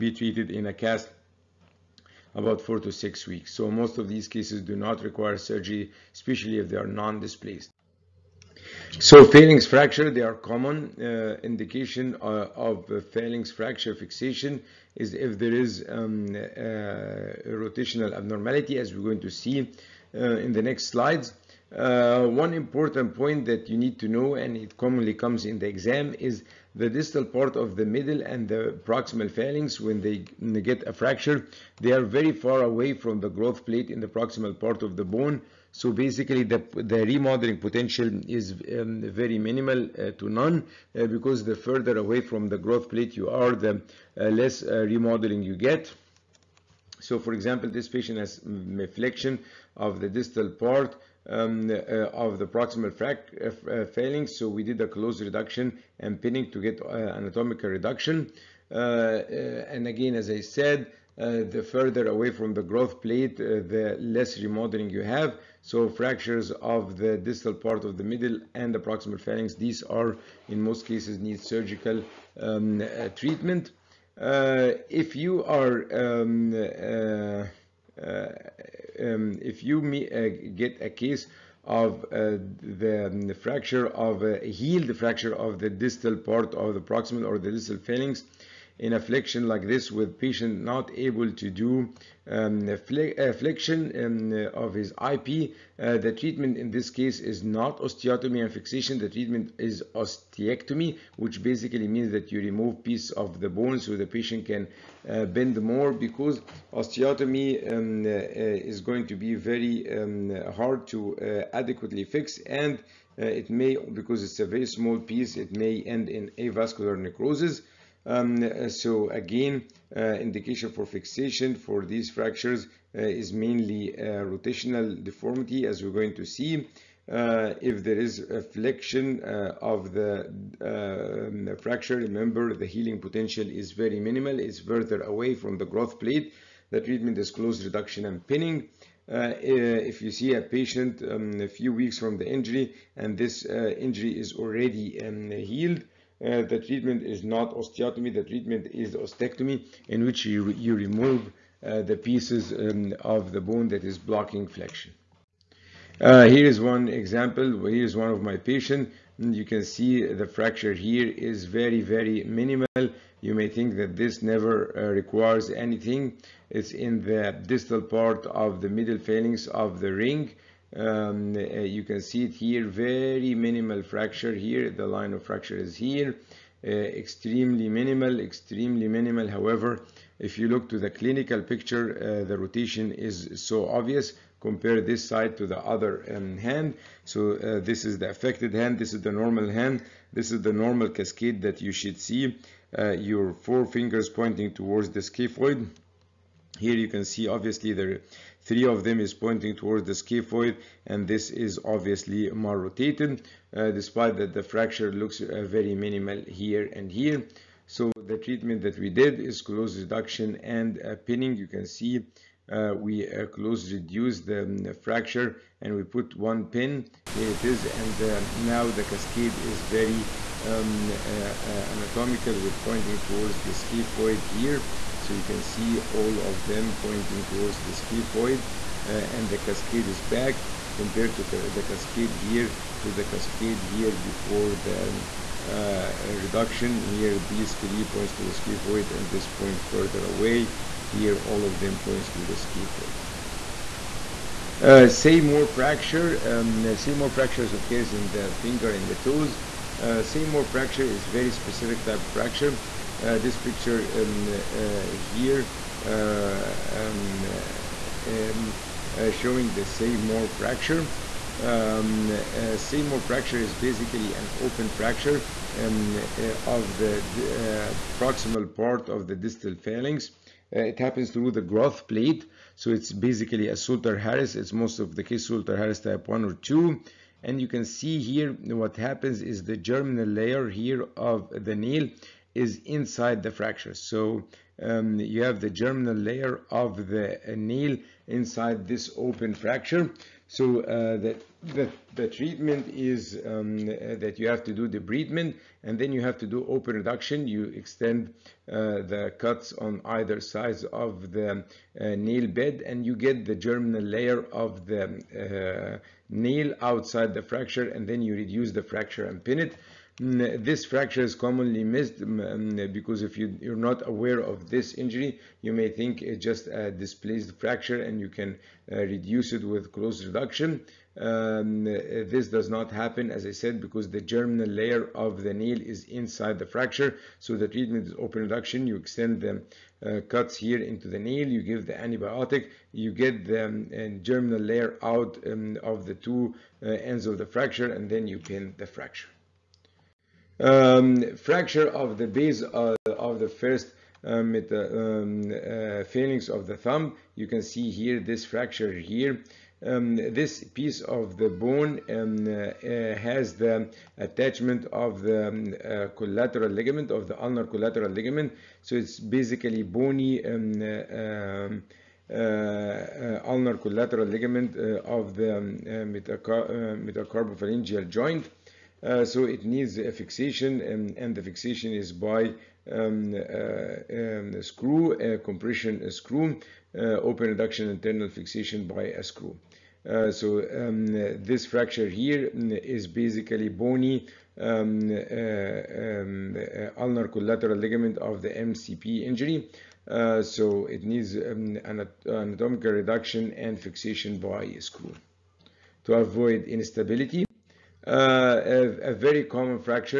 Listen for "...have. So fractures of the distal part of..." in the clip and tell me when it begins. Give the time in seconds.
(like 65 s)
65 s.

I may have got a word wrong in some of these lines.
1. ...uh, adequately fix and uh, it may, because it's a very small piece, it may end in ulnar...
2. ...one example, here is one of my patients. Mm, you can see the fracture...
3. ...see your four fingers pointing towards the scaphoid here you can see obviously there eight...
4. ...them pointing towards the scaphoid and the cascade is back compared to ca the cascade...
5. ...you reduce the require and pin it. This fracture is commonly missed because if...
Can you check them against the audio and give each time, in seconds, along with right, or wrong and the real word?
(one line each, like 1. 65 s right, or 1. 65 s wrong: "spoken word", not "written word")
1. 111 s wrong: "avascular", not "ulnar"
2. 156 s right
3. 191 s wrong: "three", not "eight"
4. 226 s right
5. 307 s wrong: "fracture", not "require".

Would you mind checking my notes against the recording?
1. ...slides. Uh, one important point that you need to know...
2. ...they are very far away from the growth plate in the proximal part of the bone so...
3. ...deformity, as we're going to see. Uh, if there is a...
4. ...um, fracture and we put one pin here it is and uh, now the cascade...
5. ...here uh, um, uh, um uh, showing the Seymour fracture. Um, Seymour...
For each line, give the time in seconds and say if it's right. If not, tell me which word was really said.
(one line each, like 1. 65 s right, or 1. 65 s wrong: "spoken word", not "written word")
1. 20 s right
2. 31 s right
3. 125 s right
4. 214 s right
5. 254 s right.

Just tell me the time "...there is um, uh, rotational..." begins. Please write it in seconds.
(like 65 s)
15 s.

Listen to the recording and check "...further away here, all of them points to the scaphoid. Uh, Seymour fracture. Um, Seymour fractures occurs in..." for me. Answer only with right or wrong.
right.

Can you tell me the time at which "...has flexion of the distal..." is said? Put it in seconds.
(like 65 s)
48 s.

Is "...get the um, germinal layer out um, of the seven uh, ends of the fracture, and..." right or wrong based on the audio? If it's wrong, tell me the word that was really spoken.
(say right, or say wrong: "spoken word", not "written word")
wrong: "two", not "seven".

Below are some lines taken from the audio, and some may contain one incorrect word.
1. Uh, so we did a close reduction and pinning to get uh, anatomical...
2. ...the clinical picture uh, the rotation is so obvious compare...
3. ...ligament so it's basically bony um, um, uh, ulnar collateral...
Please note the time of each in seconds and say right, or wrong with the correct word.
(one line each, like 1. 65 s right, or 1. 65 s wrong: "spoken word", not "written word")
1. 54 s right
2. 180 s right
3. 357 s right.